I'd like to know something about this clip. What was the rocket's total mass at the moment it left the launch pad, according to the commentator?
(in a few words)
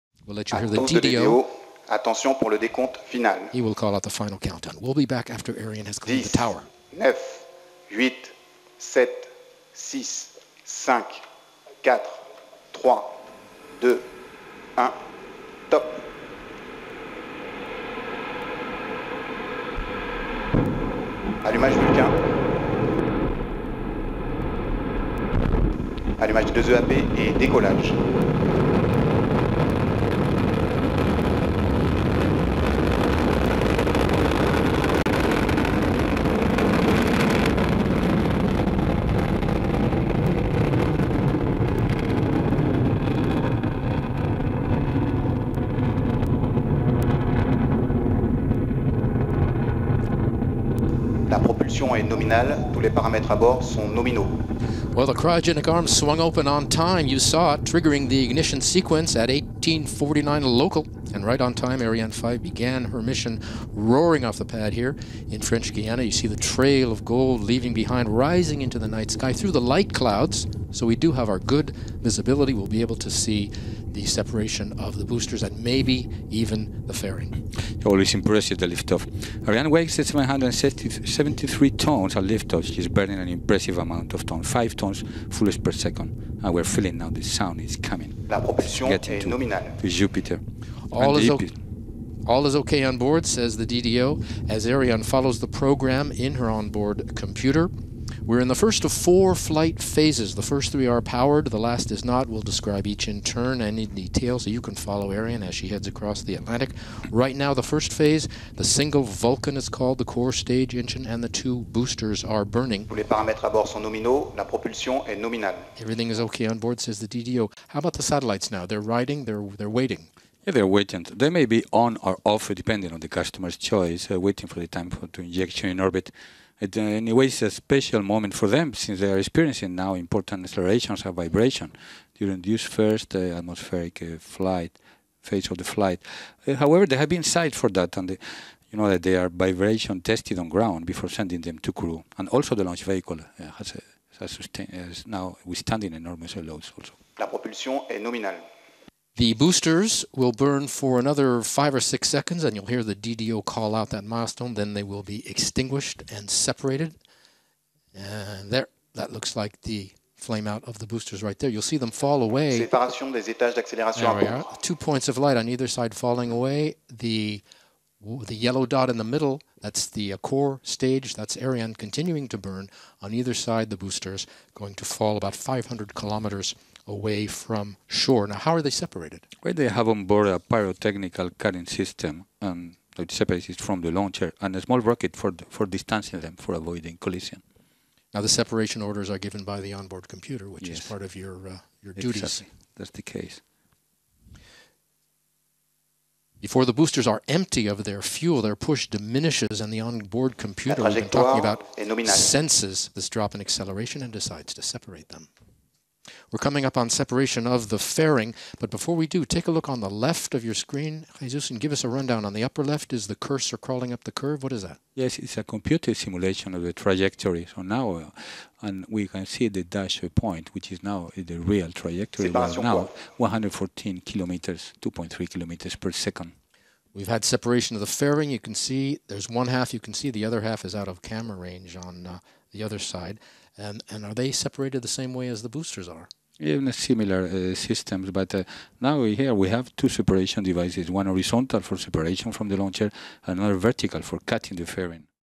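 773 tons.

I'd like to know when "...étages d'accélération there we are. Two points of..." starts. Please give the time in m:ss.
2:43.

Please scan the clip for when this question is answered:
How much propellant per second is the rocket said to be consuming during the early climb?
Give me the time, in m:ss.
1:24.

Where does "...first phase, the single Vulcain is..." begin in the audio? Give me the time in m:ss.
1:47.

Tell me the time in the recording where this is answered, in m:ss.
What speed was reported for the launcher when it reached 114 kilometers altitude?
3:44.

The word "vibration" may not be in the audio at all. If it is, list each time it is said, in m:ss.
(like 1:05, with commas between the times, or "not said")
2:11, 2:19.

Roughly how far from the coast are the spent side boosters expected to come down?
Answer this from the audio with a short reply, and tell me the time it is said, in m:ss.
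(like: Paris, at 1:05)
500 kilometers, at 2:55.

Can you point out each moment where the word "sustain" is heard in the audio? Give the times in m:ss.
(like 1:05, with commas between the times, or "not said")
2:24.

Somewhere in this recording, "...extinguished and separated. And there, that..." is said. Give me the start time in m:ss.
2:35.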